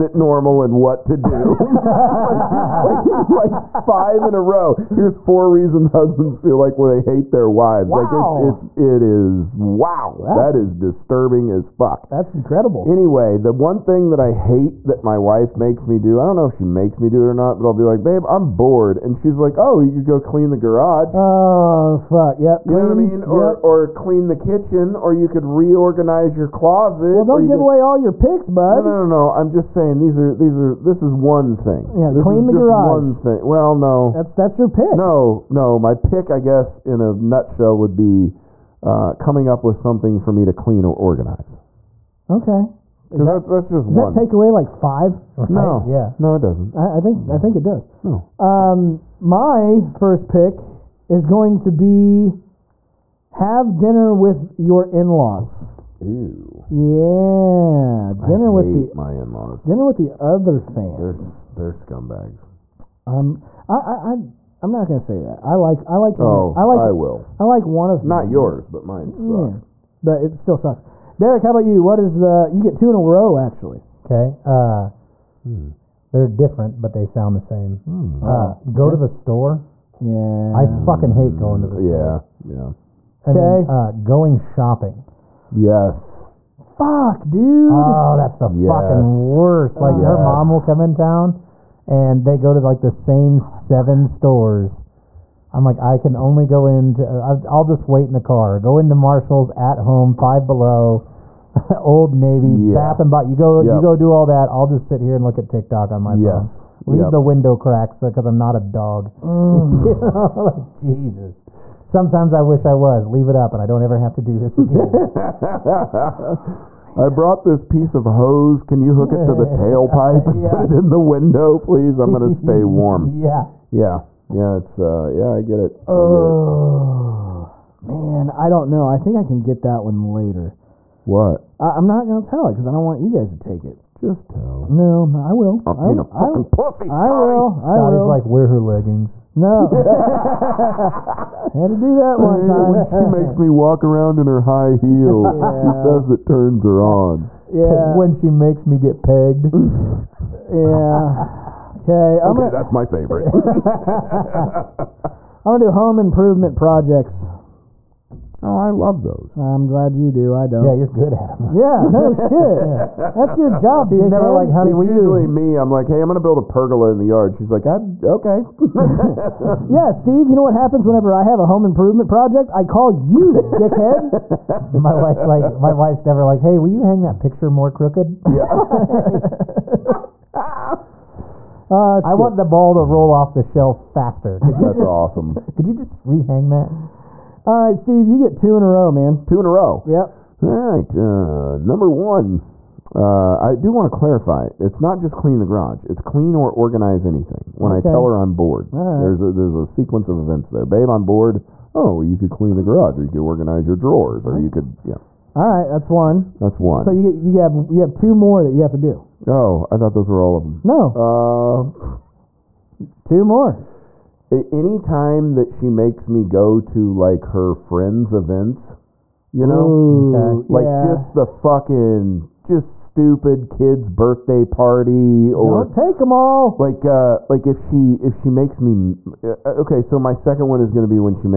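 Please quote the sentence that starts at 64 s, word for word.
I I'm not gonna say that.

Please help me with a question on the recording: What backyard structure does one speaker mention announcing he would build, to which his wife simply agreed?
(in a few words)
A pergola.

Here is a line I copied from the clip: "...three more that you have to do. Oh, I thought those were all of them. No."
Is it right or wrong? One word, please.
wrong.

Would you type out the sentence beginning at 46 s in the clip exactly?
I, I, think I think it does.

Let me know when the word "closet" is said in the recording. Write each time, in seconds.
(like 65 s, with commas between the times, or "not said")
26 s.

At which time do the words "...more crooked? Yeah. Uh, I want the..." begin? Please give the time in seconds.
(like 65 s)
177 s.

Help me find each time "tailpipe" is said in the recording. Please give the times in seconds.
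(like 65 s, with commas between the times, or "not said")
119 s.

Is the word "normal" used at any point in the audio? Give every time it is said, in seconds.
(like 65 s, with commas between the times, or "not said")
0 s.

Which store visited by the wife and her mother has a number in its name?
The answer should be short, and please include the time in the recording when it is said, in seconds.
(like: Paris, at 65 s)
Five Below, at 100 s.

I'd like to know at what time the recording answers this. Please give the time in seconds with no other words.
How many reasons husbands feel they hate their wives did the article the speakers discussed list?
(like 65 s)
5 s.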